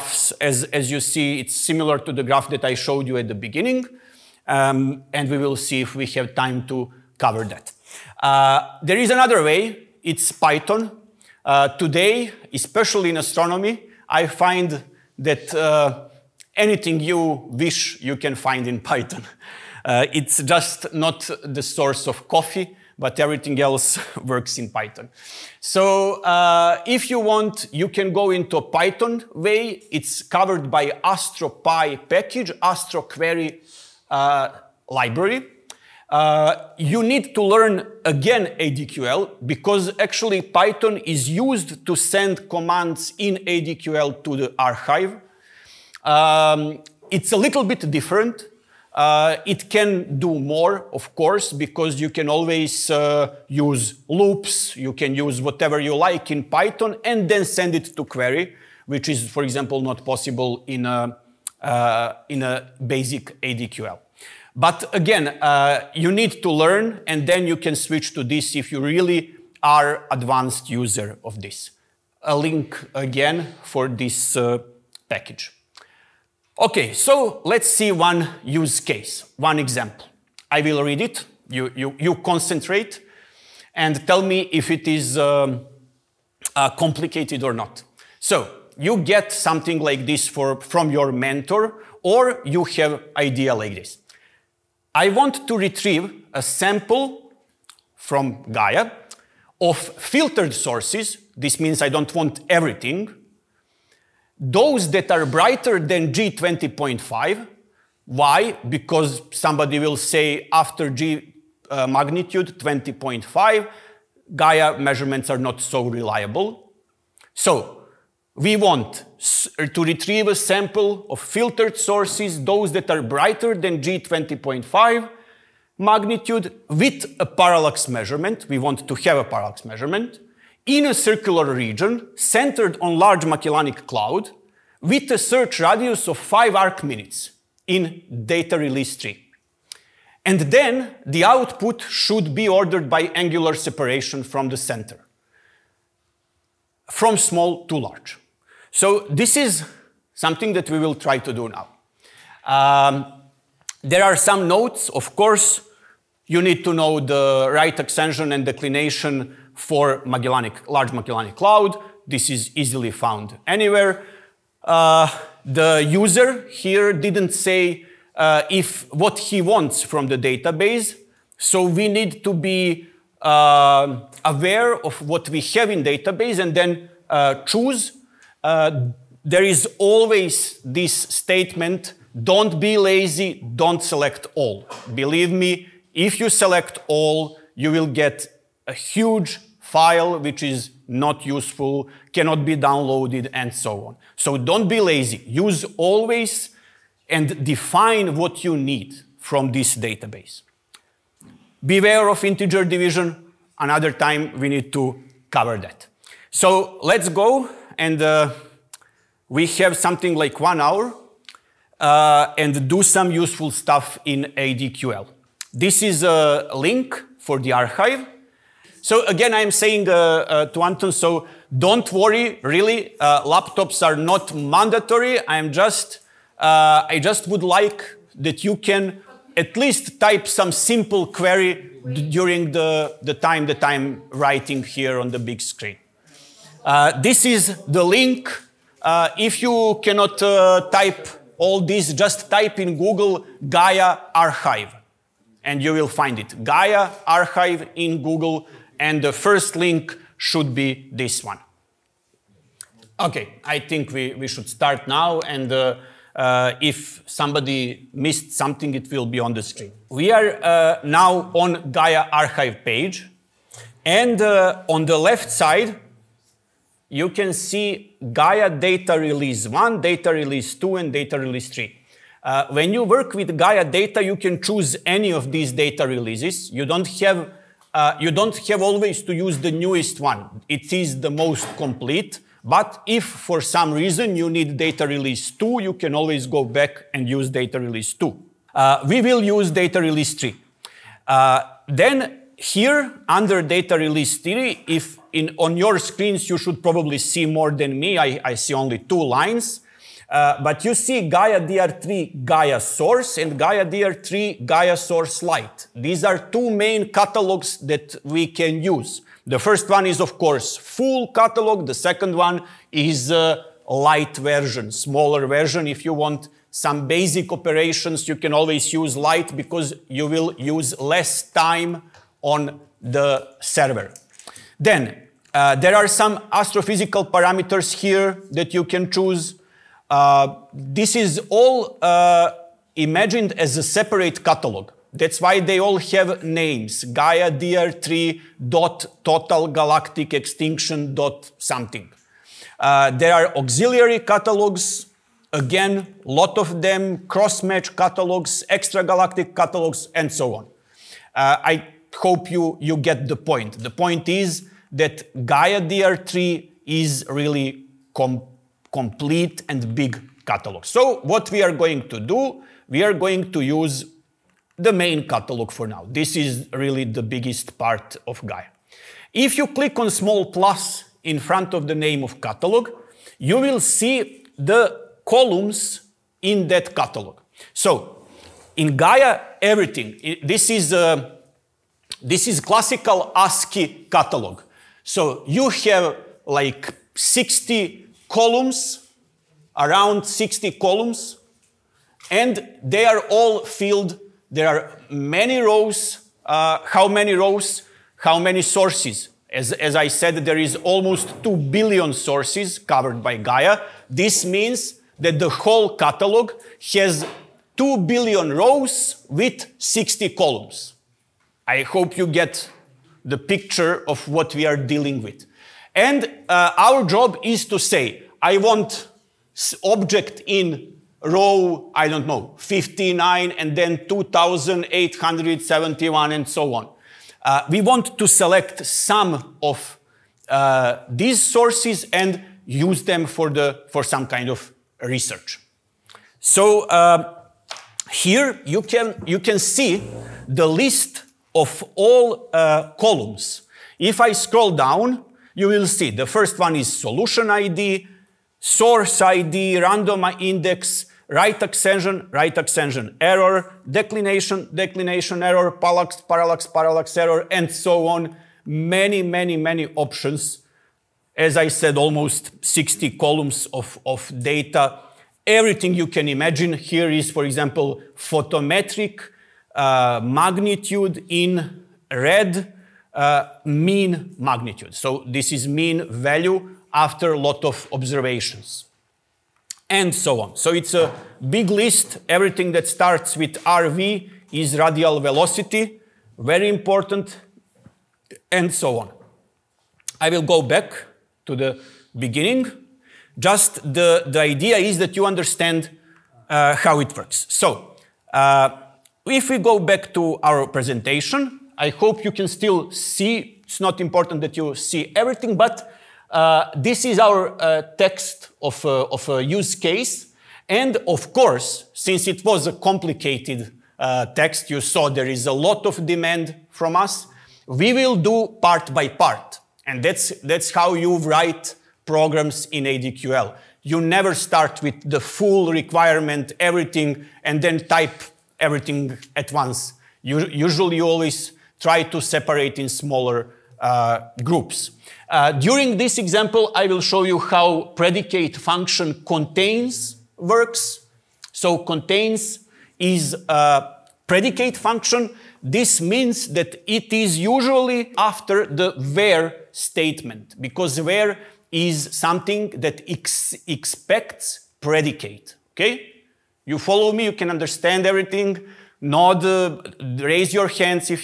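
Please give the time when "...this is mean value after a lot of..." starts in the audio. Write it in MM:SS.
07:55.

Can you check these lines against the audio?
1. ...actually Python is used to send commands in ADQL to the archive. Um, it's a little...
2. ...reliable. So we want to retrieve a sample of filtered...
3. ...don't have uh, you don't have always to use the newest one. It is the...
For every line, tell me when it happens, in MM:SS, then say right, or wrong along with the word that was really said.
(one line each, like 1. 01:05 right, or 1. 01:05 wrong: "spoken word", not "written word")
1. 00:39 right
2. 01:55 right
3. 04:36 right.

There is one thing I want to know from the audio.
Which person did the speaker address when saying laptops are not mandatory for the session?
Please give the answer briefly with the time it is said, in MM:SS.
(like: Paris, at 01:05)
Anton, at 03:40.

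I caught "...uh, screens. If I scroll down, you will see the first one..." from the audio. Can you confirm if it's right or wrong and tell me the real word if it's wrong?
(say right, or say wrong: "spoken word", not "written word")
wrong: "columns", not "screens".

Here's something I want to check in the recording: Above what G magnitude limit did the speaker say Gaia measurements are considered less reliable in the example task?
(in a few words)
20.5.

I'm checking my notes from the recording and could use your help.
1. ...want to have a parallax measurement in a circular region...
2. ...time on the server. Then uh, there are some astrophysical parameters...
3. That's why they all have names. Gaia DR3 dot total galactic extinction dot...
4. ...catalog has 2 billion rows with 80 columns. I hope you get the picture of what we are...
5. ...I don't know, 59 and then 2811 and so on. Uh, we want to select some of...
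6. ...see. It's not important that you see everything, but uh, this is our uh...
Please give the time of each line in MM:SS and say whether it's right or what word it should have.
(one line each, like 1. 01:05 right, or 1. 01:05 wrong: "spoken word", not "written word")
1. 02:08 right
2. 05:21 right
3. 05:34 right
4. 06:45 wrong: "60", not "80"
5. 07:01 wrong: "2871", not "2811"
6. 08:22 right.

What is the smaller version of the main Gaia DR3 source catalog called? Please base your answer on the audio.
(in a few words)
Gaia Source Lite.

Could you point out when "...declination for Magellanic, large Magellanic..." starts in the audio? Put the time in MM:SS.
02:38.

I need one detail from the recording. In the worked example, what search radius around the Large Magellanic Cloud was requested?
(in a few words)
5 arc minutes.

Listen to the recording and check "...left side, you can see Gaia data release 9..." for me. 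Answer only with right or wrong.
wrong.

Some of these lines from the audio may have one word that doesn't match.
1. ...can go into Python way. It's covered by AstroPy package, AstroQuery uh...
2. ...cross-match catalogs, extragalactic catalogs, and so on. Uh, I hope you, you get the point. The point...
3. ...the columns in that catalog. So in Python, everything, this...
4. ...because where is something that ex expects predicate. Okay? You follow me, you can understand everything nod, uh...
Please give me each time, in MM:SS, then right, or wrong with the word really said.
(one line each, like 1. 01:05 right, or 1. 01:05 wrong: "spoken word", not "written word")
1. 00:27 right
2. 05:47 right
3. 06:14 wrong: "Gaia", not "Python"
4. 09:10 right.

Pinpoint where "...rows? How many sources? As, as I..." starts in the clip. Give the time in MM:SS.
06:37.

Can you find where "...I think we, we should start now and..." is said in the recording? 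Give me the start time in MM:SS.
04:13.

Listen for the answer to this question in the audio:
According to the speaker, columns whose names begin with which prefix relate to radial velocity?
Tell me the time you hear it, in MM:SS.
08:03.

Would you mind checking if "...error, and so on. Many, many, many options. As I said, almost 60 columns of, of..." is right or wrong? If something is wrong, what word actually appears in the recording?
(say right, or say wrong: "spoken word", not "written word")
right.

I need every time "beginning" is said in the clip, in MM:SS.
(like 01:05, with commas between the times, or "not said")
00:03, 08:11.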